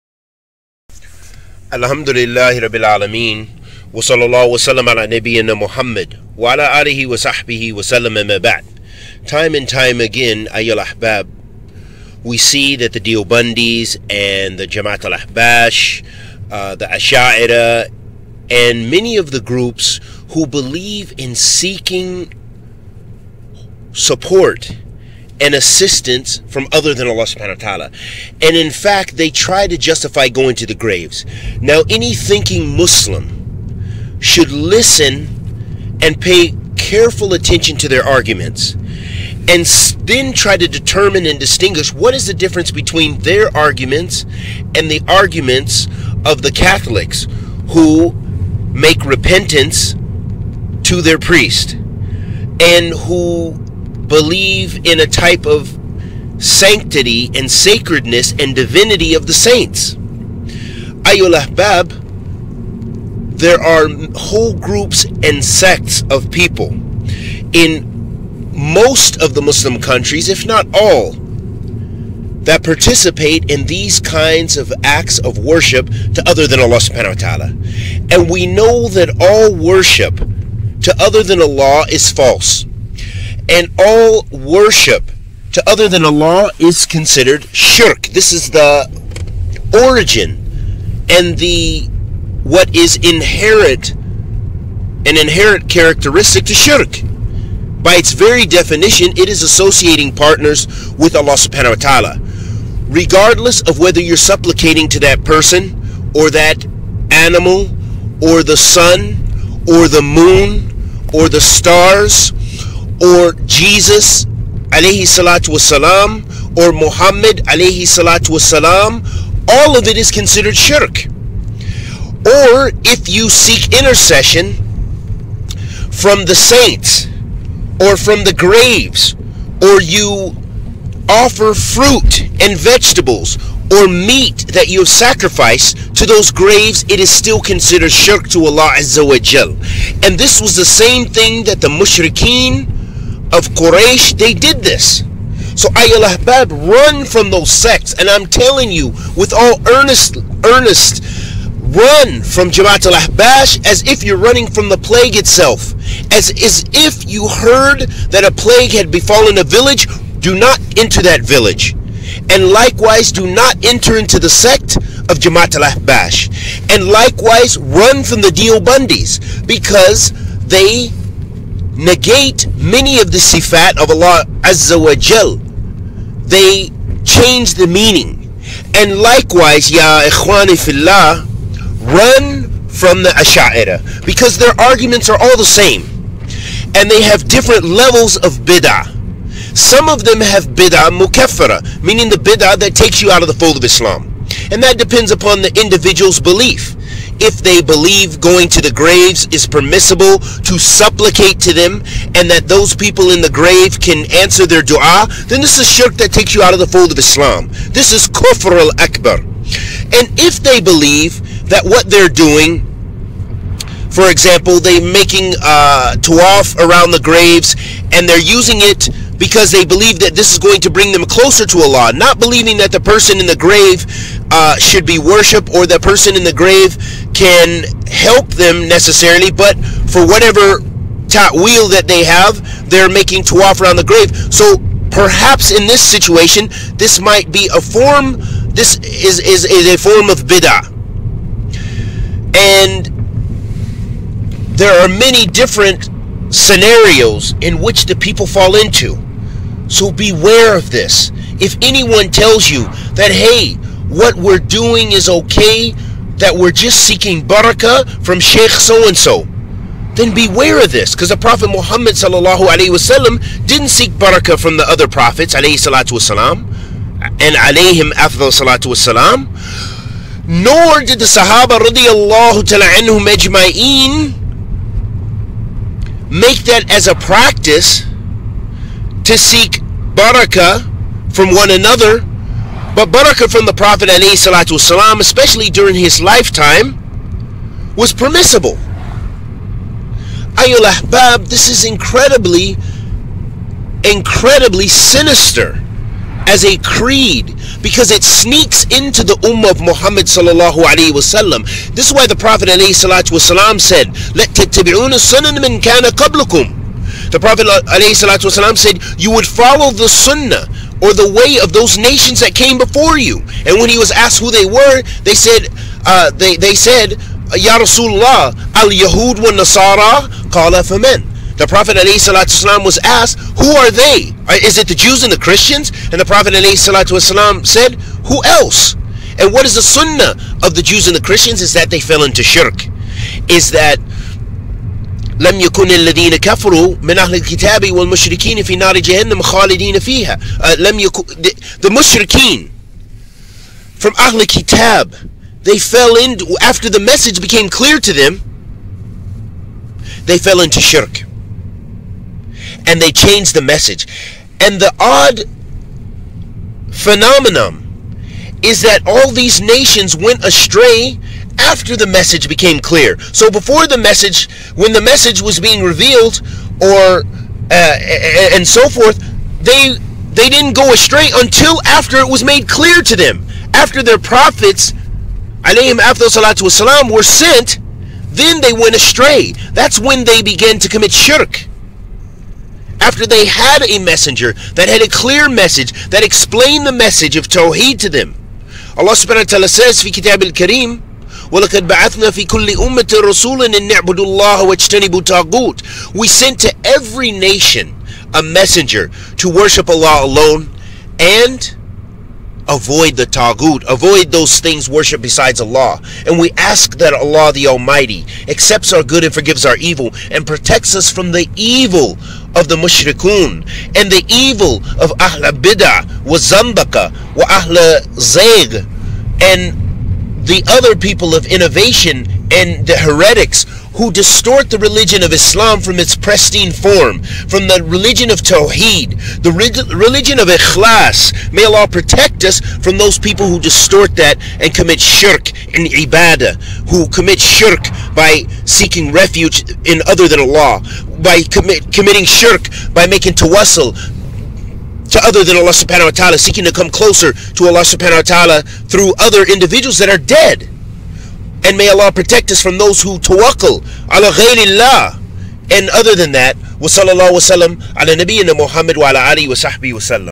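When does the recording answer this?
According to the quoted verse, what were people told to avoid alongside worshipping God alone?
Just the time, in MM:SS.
06:43.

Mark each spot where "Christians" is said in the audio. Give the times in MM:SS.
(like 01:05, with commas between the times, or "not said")
05:25, 05:31.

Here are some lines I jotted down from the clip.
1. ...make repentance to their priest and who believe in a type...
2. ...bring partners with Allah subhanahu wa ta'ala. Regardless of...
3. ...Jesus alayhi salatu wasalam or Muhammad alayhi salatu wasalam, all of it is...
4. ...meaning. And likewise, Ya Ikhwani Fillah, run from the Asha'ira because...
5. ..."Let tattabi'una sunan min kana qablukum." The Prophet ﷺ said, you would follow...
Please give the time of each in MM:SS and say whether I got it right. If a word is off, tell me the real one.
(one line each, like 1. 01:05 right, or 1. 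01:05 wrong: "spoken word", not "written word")
1. 00:48 right
2. 01:39 wrong: "associating", not "bring"
3. 01:53 right
4. 02:57 right
5. 05:04 right.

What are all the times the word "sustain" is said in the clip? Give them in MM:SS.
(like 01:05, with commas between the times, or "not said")
not said.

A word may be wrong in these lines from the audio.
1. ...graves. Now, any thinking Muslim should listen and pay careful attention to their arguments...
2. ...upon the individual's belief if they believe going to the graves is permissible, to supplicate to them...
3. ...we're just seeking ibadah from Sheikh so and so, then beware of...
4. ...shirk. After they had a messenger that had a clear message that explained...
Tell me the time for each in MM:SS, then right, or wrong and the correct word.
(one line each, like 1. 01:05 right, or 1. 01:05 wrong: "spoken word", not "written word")
1. 00:30 right
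2. 03:15 right
3. 04:16 wrong: "barakah", not "ibadah"
4. 06:20 right.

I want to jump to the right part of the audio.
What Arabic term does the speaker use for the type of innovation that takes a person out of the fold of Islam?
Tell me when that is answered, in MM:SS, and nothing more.
03:10.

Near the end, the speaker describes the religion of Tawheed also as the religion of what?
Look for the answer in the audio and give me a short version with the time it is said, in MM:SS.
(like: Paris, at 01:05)
Ikhlas, at 07:10.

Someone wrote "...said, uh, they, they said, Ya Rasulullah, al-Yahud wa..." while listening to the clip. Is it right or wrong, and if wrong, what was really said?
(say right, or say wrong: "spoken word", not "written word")
right.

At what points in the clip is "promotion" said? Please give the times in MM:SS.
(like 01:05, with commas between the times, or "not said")
not said.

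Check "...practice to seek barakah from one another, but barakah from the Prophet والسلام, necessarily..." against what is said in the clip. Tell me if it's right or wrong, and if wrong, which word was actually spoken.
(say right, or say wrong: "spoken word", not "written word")
wrong: "especially", not "necessarily".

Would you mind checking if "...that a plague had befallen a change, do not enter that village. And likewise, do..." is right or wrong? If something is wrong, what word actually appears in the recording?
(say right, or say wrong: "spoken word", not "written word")
wrong: "village", not "change".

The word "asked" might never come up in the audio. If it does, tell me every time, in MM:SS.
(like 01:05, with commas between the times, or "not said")
05:13, 05:22.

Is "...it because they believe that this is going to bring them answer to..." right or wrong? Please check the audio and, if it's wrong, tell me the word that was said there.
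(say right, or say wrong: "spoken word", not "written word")
wrong: "closer", not "answer".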